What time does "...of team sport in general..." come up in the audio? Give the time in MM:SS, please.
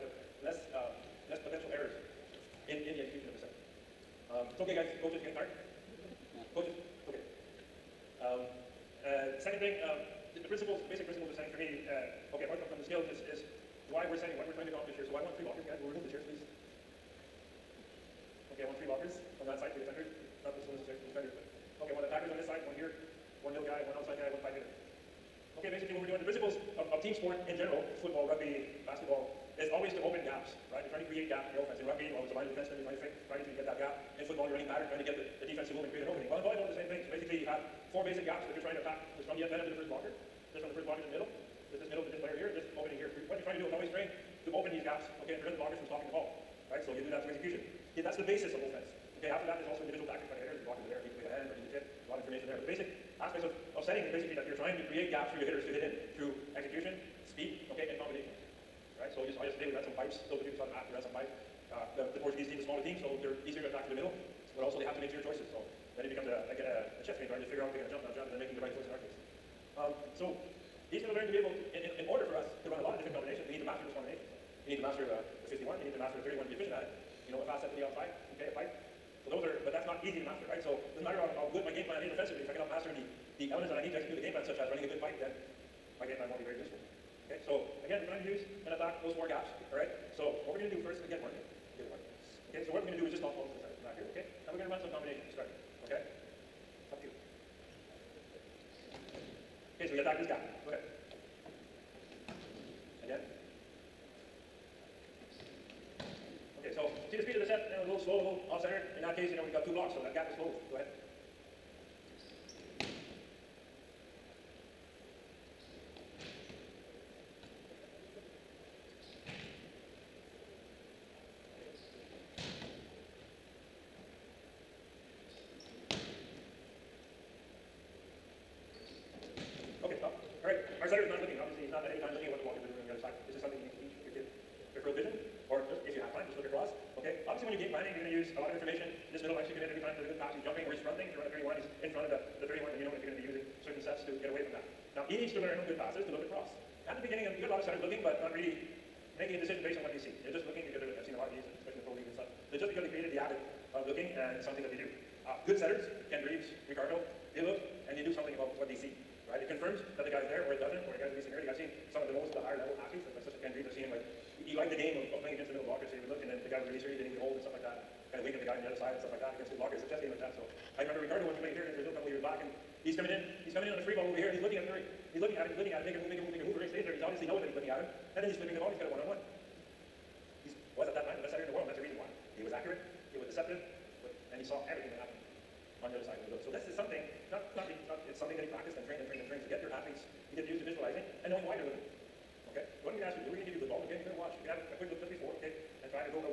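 00:26.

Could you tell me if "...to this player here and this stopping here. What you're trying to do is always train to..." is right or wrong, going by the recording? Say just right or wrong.
wrong.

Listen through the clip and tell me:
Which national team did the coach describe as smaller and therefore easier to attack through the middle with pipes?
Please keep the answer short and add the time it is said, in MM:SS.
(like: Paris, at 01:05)
Portuguese team, at 01:02.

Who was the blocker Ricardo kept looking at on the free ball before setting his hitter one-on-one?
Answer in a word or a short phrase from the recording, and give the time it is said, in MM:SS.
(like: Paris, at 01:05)
Murray, at 02:54.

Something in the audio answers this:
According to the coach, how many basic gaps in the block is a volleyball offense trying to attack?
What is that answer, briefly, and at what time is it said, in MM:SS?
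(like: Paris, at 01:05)
4, at 00:37.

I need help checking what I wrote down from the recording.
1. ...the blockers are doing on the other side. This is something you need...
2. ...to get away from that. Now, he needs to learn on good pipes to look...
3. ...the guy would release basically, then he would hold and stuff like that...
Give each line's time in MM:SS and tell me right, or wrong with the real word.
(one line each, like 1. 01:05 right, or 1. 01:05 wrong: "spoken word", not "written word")
1. 02:12 right
2. 02:24 wrong: "passes", not "pipes"
3. 02:46 wrong: "early", not "basically".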